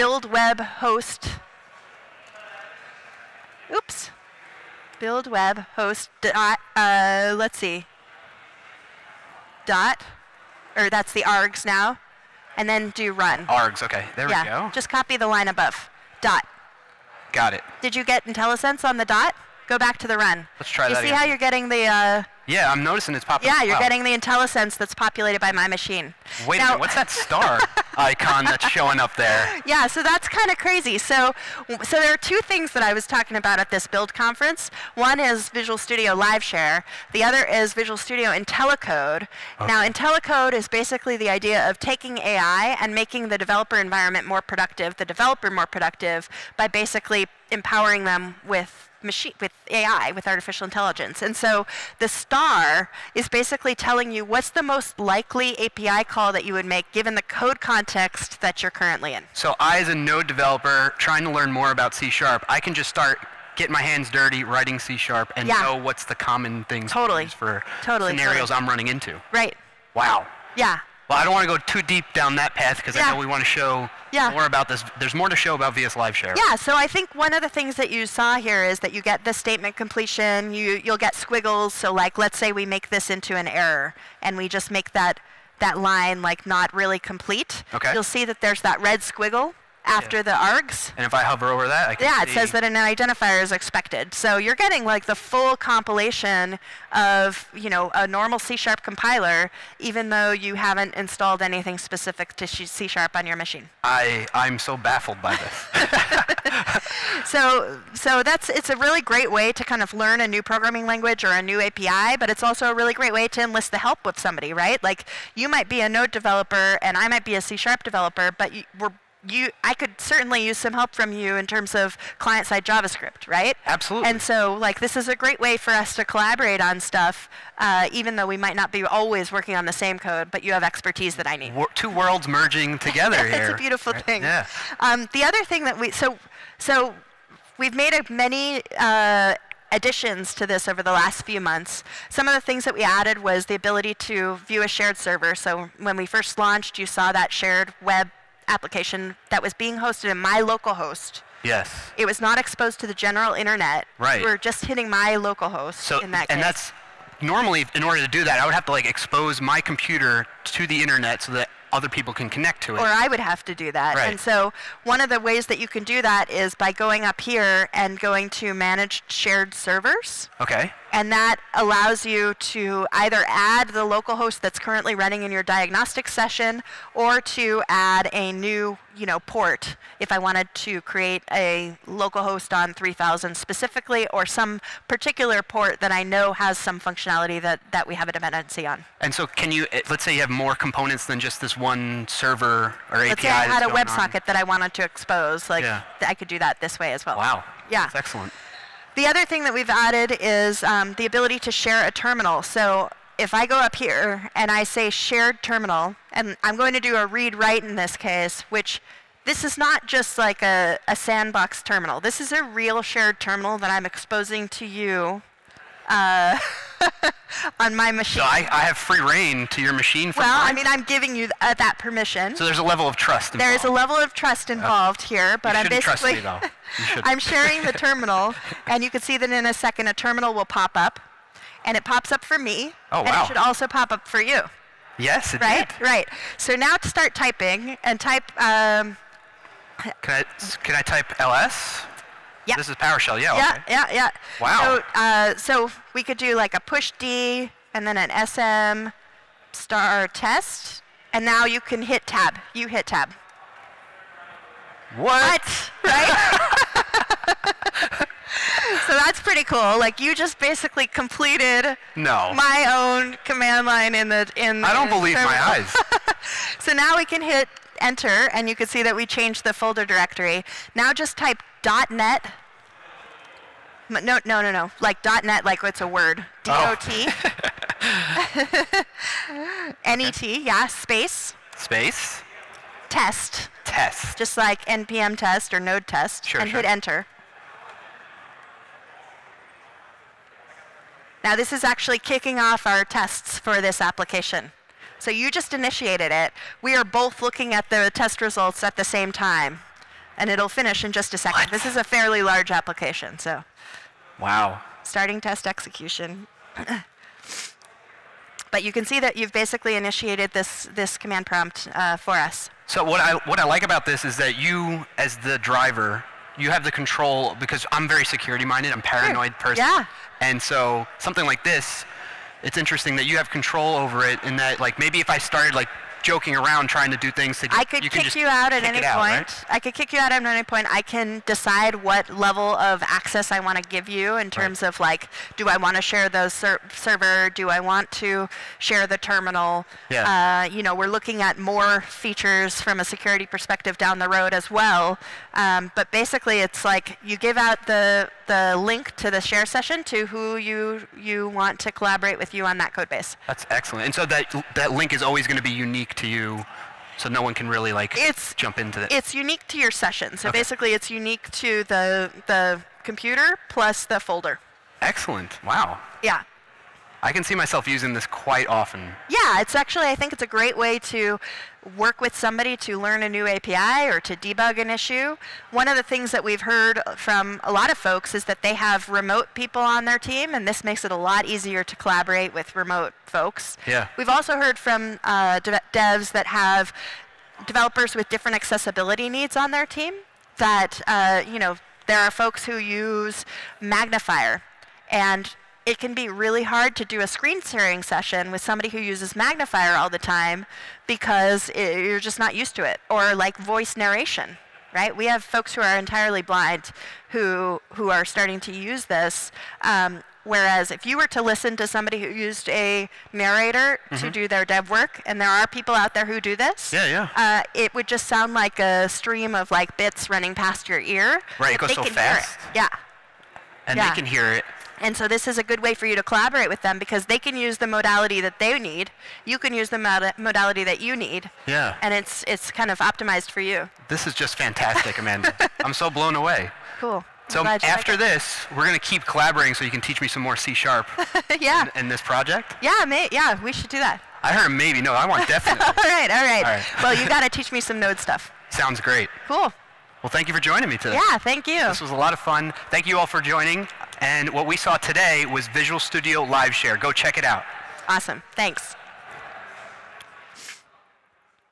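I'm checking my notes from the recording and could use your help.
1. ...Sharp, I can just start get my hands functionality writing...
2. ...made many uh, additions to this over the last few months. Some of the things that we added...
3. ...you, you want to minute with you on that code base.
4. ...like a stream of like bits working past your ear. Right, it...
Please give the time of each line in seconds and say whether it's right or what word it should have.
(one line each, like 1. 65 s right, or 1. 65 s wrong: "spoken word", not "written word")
1. 62 s wrong: "dirty", not "functionality"
2. 137 s right
3. 350 s wrong: "collaborate", not "minute"
4. 418 s wrong: "running", not "working".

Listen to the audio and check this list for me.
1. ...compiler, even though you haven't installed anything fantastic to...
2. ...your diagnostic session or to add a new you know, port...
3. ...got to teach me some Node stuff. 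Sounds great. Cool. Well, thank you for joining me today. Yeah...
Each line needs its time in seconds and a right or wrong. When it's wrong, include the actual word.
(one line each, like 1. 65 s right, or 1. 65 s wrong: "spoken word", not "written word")
1. 98 s wrong: "specific", not "fantastic"
2. 175 s right
3. 447 s right.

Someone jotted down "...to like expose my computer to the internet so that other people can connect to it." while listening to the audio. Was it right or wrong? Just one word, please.
right.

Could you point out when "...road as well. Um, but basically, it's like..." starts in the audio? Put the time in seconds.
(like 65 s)
344 s.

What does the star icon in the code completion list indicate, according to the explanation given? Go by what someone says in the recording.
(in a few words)
Most likely API call.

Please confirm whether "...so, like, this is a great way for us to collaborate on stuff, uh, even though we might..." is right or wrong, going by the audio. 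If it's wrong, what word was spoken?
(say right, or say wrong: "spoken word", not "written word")
right.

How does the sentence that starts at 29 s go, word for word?
Yeah, so that's kind of crazy.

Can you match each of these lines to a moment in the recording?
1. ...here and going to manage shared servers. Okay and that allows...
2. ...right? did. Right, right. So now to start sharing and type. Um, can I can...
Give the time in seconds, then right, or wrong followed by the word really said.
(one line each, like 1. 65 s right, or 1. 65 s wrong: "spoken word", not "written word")
1. 167 s right
2. 235 s wrong: "typing", not "sharing".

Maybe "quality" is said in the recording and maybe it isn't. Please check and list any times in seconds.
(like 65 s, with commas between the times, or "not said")
not said.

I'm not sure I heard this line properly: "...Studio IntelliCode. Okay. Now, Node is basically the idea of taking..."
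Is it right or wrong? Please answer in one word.
wrong.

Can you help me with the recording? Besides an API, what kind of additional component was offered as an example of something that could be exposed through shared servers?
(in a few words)
A WebSocket.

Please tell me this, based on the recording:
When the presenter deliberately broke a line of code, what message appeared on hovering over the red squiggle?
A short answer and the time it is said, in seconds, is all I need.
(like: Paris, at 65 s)
An identifier is expected, at 92 s.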